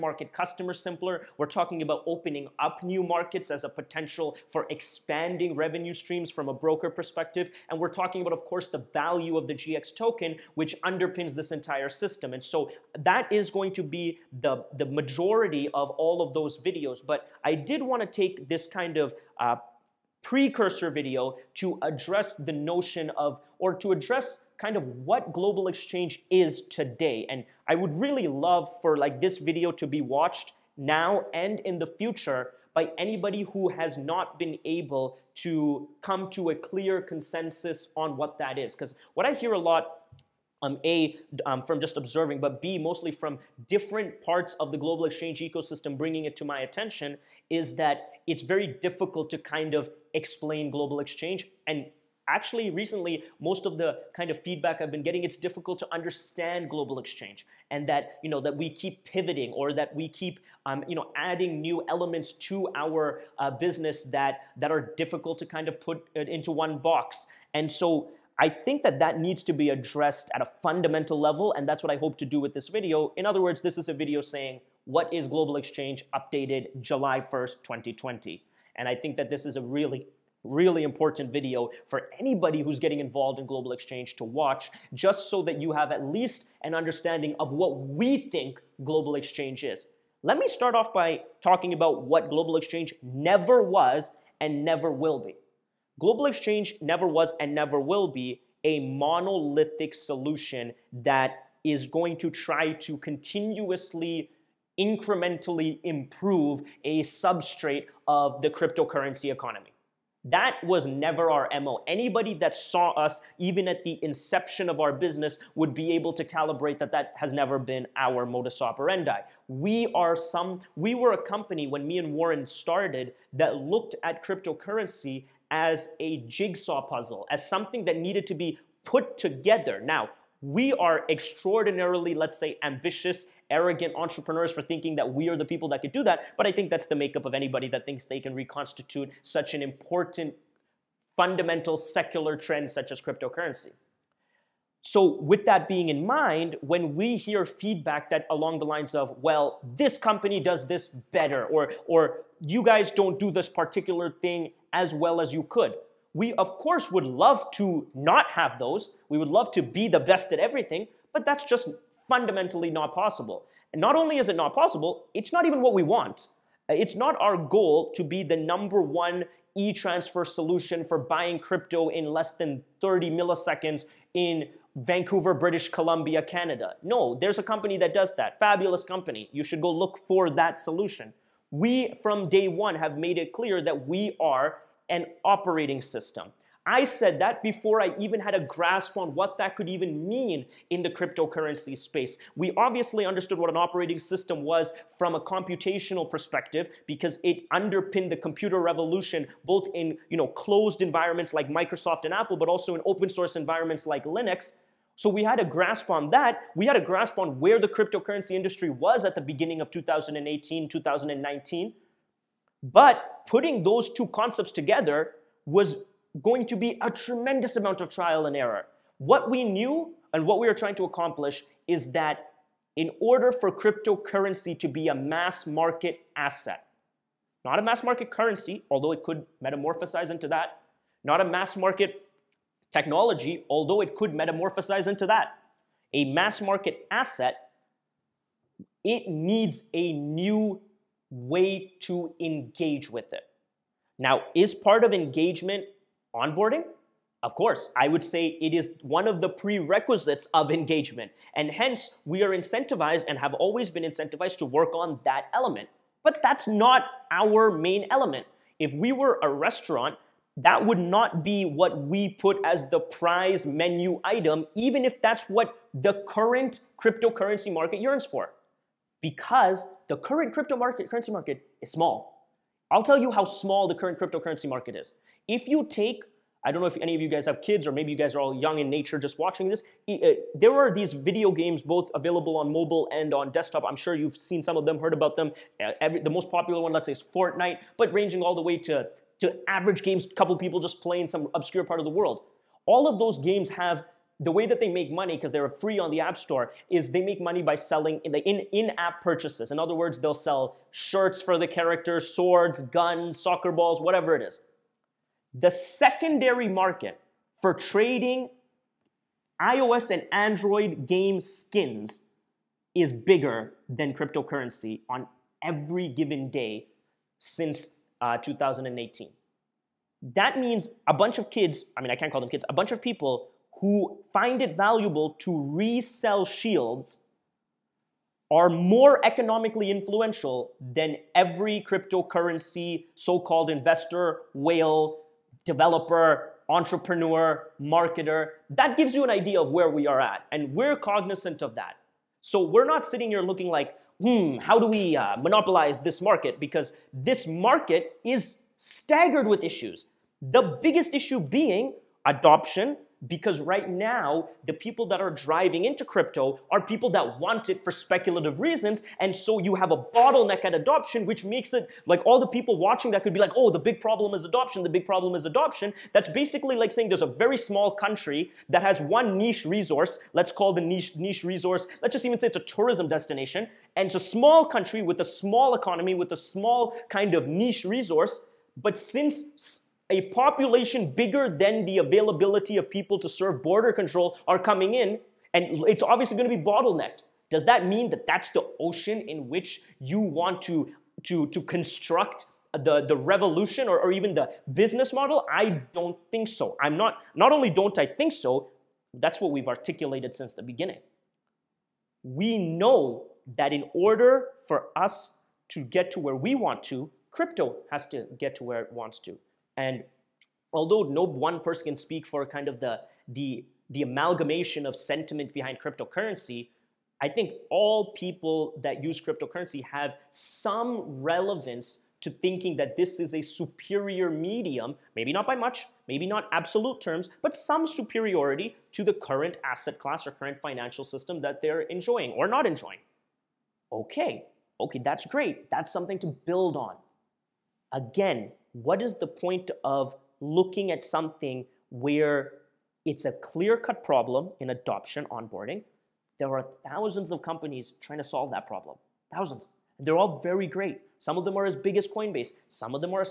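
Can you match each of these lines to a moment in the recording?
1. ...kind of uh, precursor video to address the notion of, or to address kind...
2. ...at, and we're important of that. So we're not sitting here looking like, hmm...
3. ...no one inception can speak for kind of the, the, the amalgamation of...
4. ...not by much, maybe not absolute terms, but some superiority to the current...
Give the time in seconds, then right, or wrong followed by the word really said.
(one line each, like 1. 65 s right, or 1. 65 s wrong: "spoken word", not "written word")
1. 18 s right
2. 340 s wrong: "cognizant", not "important"
3. 410 s wrong: "person", not "inception"
4. 425 s right.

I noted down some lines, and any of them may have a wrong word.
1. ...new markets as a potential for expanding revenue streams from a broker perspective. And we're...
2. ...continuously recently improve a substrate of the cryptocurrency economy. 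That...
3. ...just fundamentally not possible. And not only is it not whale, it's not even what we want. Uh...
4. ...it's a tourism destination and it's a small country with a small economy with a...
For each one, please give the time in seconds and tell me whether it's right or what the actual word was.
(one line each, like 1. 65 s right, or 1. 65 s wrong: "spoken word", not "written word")
1. 2 s right
2. 102 s wrong: "incrementally", not "recently"
3. 161 s wrong: "possible", not "whale"
4. 372 s right.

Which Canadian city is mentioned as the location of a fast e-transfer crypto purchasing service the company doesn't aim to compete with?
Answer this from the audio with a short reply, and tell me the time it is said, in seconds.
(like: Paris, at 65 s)
Vancouver, at 174 s.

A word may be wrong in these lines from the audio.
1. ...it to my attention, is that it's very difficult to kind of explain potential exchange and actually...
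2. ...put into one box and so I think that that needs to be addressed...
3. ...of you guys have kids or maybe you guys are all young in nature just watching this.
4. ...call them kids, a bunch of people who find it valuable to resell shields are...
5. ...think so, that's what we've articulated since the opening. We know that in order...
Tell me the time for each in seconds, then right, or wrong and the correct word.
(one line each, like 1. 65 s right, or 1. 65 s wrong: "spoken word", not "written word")
1. 46 s wrong: "global", not "potential"
2. 65 s right
3. 276 s right
4. 322 s right
5. 397 s wrong: "beginning", not "opening".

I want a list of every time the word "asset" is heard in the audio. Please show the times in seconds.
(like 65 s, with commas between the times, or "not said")
226 s, 236 s, 429 s.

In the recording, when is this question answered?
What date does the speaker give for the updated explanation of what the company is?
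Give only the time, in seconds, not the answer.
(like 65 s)
76 s.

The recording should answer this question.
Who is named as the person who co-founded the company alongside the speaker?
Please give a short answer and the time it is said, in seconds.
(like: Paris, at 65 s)
Warren, at 122 s.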